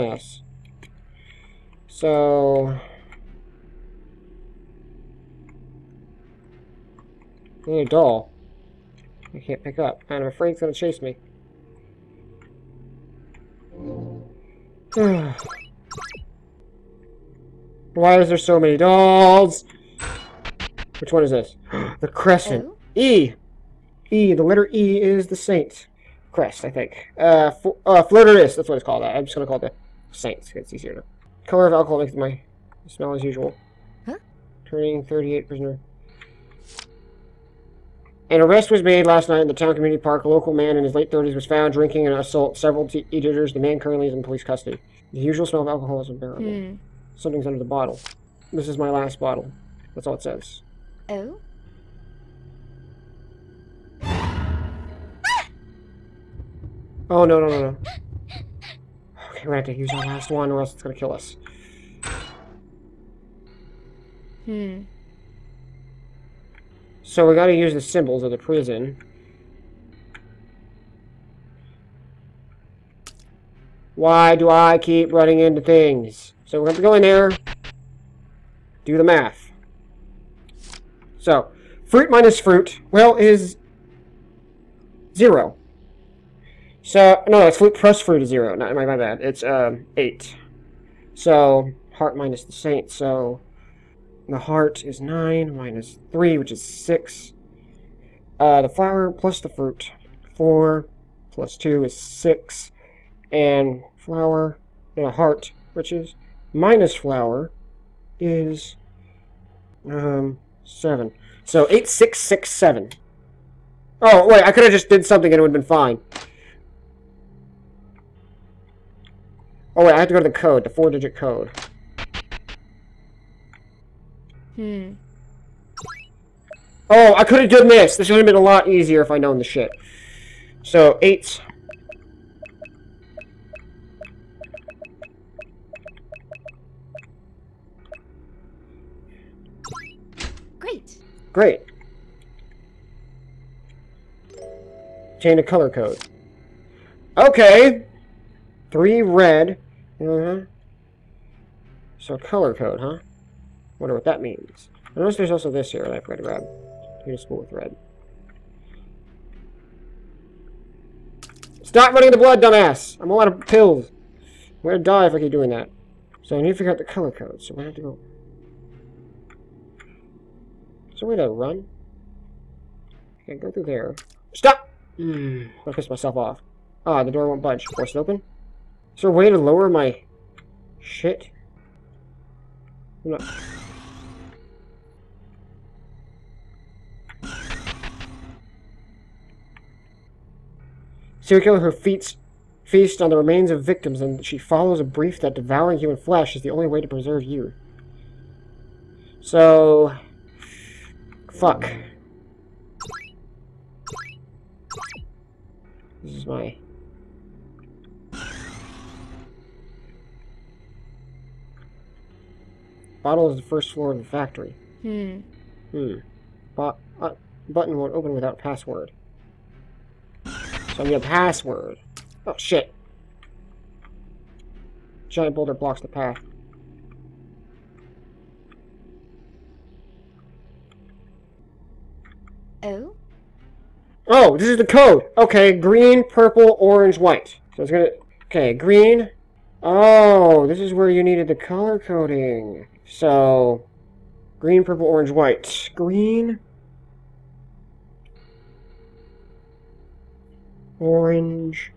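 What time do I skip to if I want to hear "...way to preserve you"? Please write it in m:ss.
3:16.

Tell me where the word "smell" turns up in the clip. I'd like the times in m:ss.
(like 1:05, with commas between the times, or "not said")
0:32, 0:45.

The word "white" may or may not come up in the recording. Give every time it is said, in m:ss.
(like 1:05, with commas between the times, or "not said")
3:56, 4:05.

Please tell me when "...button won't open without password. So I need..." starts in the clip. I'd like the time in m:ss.
3:37.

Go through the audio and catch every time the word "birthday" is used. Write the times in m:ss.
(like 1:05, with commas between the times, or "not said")
not said.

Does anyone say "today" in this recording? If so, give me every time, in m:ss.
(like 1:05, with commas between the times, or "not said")
not said.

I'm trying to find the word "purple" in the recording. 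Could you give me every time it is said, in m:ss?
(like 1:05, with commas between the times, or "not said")
3:56, 4:04.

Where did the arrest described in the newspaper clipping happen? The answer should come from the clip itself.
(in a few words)
town community park.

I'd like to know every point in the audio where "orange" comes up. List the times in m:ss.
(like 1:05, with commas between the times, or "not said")
3:56, 4:04, 4:10.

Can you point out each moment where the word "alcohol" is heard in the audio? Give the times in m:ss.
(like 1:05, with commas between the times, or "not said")
0:31, 0:45.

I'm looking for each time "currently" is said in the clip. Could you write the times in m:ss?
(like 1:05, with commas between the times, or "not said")
0:43.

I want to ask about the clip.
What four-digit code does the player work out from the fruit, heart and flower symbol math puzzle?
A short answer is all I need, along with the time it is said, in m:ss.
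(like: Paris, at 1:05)
8667, at 1:51.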